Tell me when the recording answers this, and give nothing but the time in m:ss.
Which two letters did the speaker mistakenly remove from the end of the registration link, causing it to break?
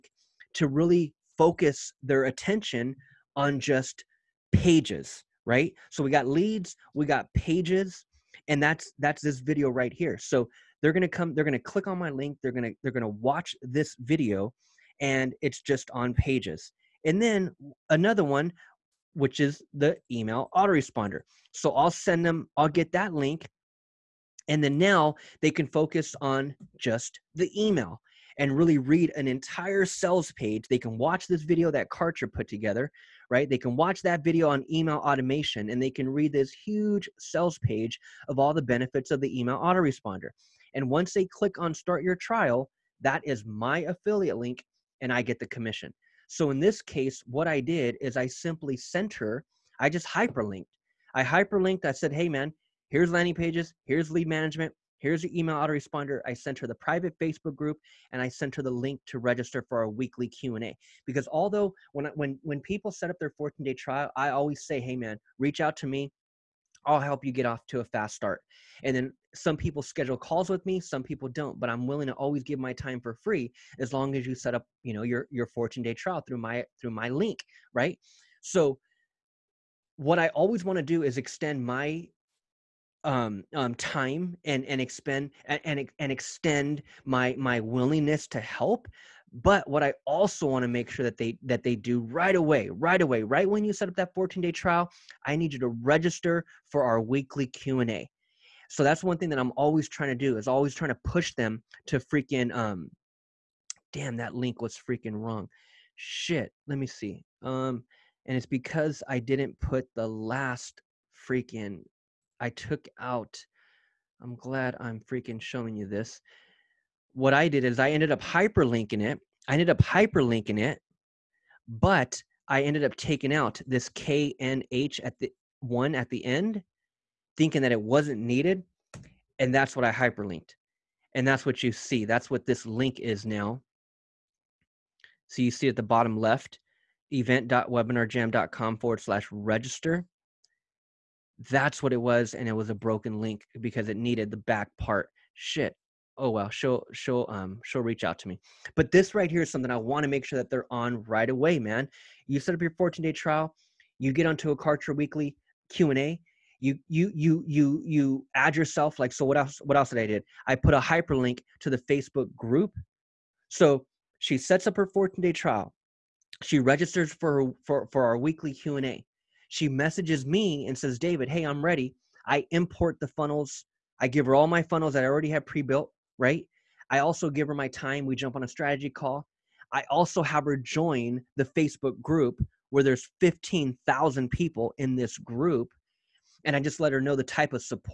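2:03.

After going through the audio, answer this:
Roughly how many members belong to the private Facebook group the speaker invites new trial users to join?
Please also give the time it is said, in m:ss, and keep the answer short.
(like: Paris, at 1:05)
15,000, at 3:03.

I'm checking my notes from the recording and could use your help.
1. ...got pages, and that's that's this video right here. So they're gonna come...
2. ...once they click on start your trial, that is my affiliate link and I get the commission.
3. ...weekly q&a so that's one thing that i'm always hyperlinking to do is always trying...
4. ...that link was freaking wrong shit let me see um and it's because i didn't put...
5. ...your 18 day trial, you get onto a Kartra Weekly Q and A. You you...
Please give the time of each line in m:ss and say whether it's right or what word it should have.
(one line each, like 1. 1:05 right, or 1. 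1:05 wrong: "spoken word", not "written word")
1. 0:07 right
2. 0:40 right
3. 1:36 wrong: "trying", not "hyperlinking"
4. 1:44 right
5. 2:32 wrong: "14", not "18".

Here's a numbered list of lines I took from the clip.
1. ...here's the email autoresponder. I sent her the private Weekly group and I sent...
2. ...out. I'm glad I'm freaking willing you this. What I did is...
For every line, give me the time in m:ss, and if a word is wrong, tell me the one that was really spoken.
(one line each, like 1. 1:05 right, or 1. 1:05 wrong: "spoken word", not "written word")
1. 0:54 wrong: "Facebook", not "Weekly"
2. 1:52 wrong: "showing", not "willing".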